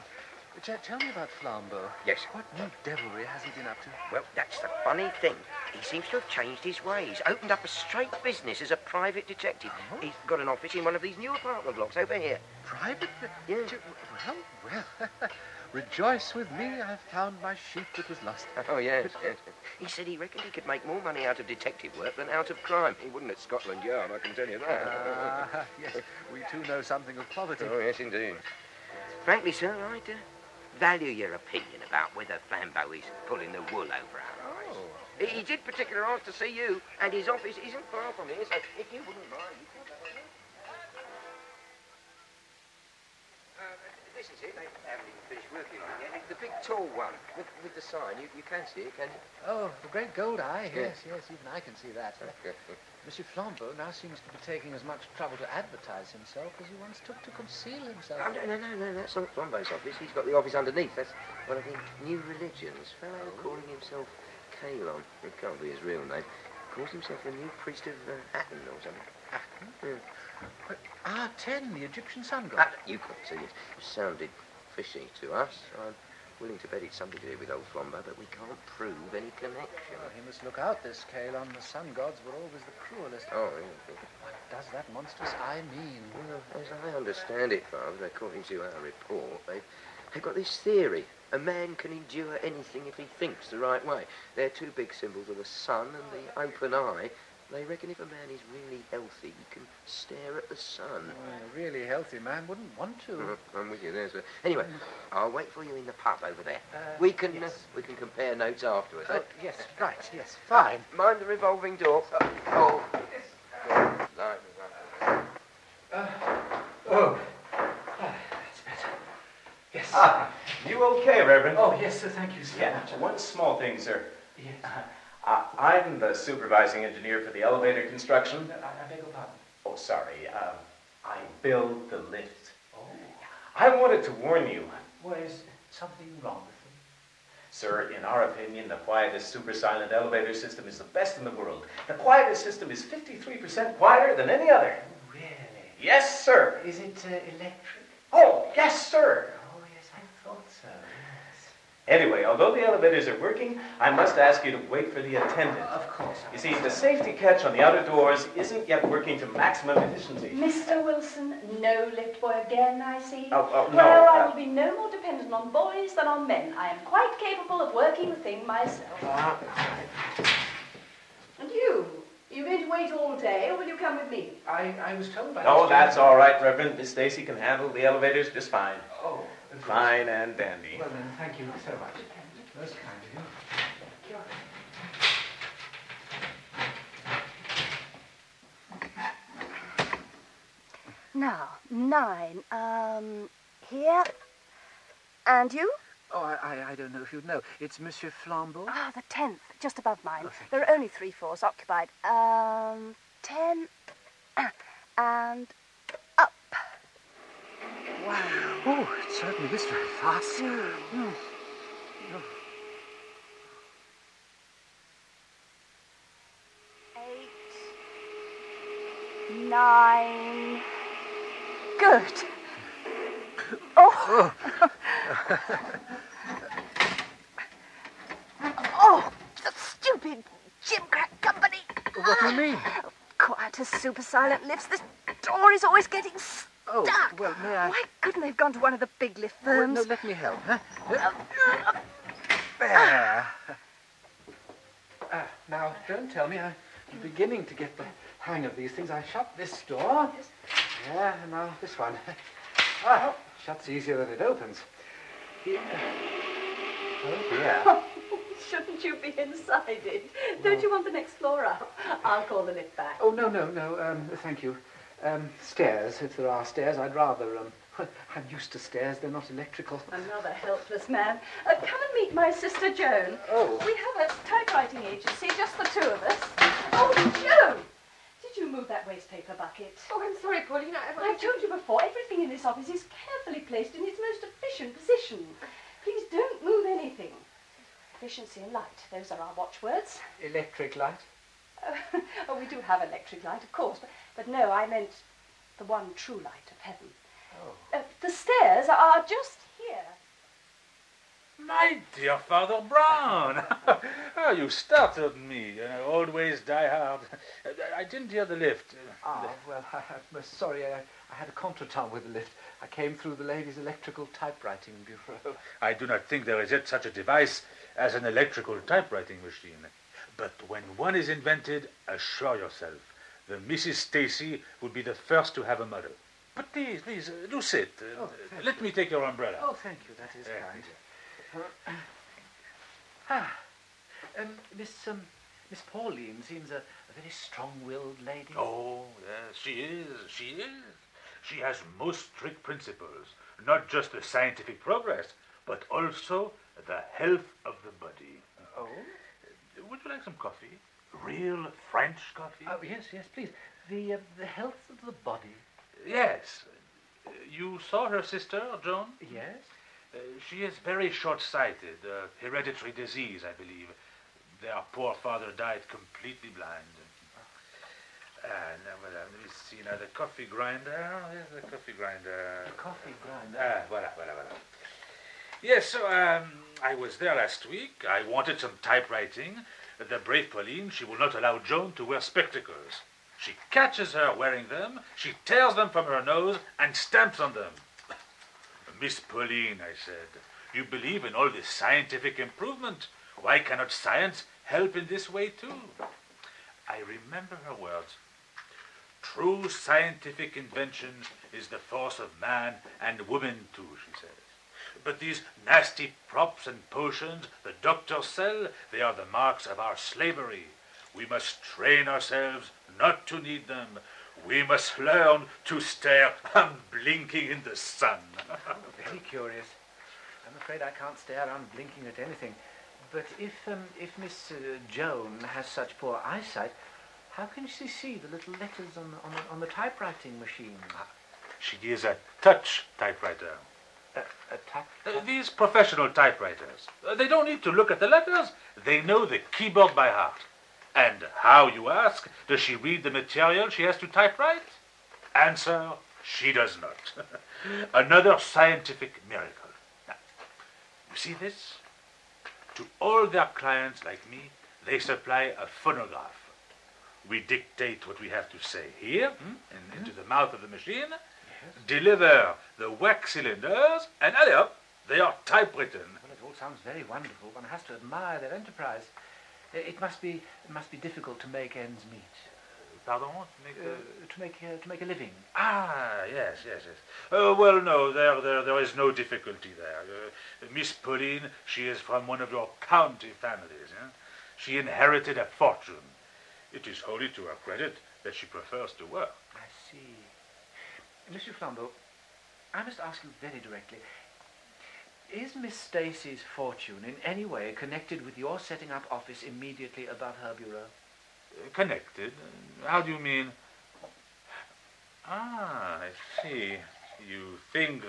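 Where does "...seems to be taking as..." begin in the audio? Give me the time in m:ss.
0:53.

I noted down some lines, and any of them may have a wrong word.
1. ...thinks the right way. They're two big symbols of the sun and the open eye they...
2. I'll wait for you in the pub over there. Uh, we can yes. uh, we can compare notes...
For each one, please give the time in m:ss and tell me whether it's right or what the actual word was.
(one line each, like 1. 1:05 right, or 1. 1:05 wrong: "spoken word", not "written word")
1. 1:33 right
2. 1:45 right.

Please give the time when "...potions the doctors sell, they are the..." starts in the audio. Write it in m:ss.
6:46.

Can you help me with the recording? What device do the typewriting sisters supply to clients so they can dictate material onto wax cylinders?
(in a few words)
phonograph.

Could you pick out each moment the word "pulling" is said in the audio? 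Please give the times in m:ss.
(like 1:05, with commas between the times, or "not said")
0:33.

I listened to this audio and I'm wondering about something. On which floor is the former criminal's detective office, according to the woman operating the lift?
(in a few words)
10th.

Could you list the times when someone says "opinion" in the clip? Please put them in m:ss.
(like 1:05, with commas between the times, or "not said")
0:31, 2:18.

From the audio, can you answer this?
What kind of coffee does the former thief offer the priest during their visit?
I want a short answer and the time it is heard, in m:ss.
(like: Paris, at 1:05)
French coffee, at 5:51.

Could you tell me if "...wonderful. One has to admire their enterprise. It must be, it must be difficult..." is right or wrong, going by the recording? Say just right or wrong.
right.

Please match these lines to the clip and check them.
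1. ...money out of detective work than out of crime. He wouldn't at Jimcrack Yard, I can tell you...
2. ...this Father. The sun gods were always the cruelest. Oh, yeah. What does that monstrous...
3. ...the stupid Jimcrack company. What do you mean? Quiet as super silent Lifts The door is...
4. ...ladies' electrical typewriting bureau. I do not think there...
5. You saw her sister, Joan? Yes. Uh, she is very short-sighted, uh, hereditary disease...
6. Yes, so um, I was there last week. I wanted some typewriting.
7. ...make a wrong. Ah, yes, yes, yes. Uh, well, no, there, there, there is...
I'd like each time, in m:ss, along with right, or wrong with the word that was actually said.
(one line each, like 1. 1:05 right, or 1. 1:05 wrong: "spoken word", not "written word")
1. 0:21 wrong: "Scotland", not "Jimcrack"
2. 1:20 wrong: "Kalon", not "Father"
3. 3:49 right
4. 5:13 right
5. 5:57 right
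6. 6:15 right
7. 7:54 wrong: "living", not "wrong".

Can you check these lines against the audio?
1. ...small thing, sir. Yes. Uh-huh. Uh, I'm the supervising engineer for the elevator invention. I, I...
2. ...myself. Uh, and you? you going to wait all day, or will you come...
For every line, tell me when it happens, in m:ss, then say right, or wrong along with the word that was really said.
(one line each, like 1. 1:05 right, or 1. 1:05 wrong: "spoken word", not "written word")
1. 2:03 wrong: "construction", not "invention"
2. 2:48 right.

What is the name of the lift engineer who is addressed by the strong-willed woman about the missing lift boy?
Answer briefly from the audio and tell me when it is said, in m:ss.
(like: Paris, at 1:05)
Mr. Wilson, at 2:40.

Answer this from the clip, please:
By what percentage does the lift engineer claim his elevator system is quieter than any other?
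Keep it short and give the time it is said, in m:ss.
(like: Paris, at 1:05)
53%, at 2:22.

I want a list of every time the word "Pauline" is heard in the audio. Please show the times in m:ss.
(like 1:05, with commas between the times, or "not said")
4:40, 5:35, 6:20, 6:29, 8:00.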